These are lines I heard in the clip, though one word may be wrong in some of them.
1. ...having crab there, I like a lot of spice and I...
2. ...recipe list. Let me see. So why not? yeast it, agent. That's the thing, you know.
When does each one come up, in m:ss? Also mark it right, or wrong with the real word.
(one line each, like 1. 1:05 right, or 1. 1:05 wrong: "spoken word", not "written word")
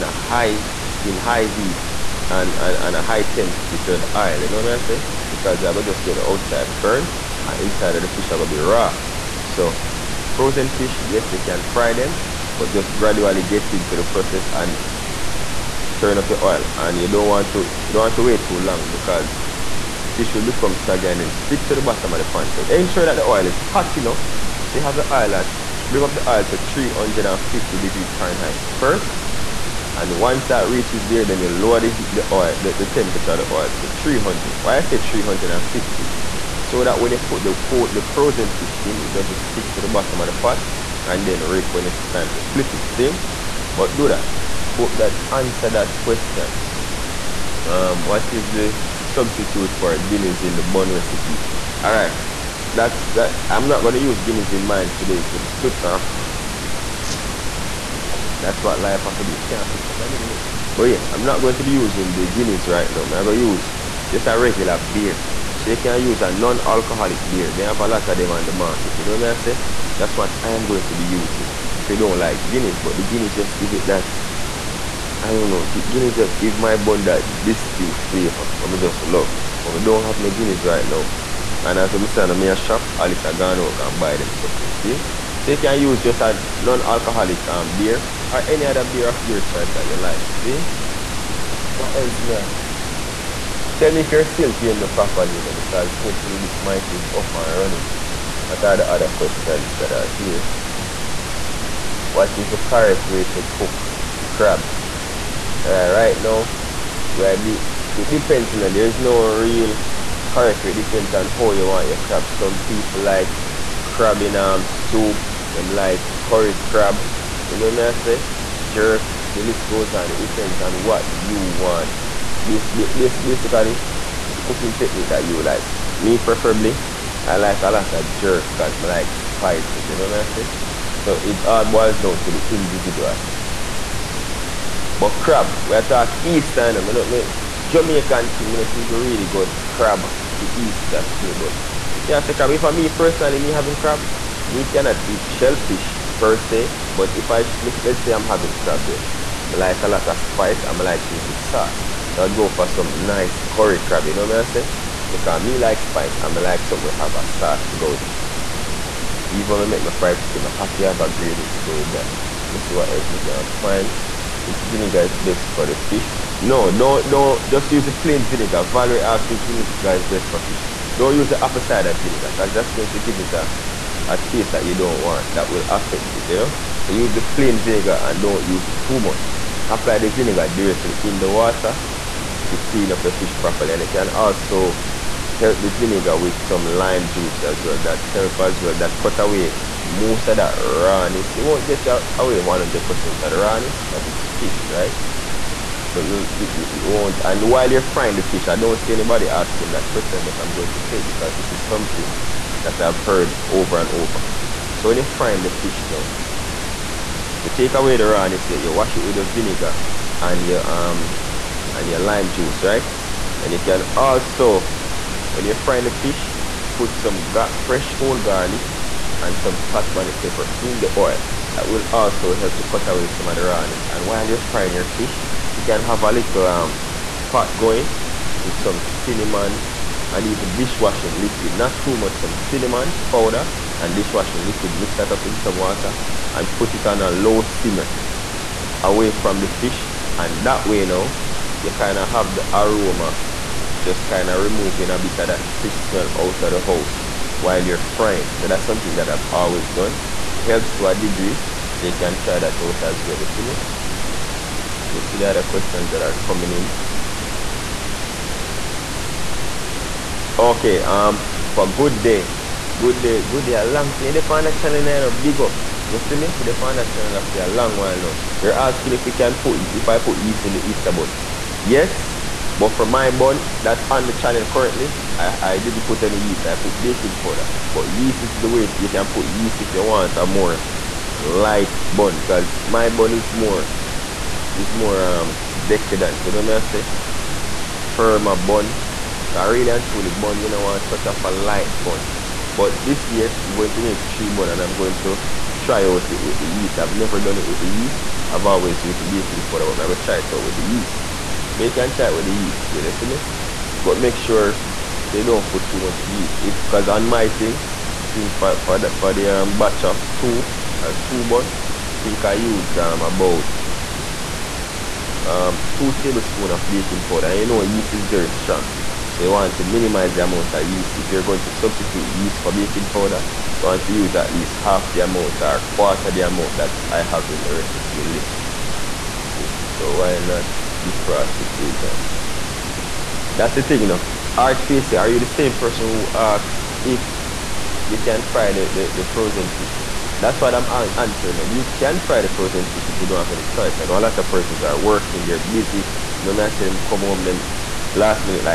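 1. 2:28 right
2. 5:27 wrong: "defrost", not "yeast".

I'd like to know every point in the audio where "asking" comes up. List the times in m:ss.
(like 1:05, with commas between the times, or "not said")
3:19, 4:28.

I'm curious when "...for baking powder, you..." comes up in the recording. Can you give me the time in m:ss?
5:22.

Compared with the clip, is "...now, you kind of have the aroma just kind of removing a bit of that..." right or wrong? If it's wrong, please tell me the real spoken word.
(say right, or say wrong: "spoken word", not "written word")
right.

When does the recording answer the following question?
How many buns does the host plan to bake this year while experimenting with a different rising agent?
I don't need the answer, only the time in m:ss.
4:54.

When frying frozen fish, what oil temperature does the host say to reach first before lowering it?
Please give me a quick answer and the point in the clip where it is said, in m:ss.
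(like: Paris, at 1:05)
350 degrees Fahrenheit, at 0:26.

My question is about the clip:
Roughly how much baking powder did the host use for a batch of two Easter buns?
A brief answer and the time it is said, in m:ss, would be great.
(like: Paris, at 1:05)
2 tablespoons, at 5:15.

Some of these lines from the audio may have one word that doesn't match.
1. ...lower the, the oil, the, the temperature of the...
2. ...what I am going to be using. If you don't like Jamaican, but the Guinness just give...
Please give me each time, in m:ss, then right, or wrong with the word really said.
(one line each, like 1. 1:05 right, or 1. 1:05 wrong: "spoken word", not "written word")
1. 0:31 right
2. 1:10 wrong: "Guinness", not "Jamaican".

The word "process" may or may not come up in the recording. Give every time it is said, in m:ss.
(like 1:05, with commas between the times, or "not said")
0:14.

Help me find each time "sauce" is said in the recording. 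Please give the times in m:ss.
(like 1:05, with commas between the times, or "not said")
2:31, 2:37.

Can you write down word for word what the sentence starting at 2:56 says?
So use the plain vinegar and don't use too much.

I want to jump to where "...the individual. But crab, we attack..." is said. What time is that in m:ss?
2:12.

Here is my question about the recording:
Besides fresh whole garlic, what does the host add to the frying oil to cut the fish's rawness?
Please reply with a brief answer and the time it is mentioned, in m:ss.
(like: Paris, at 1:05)
scotch bonnet pepper, at 3:39.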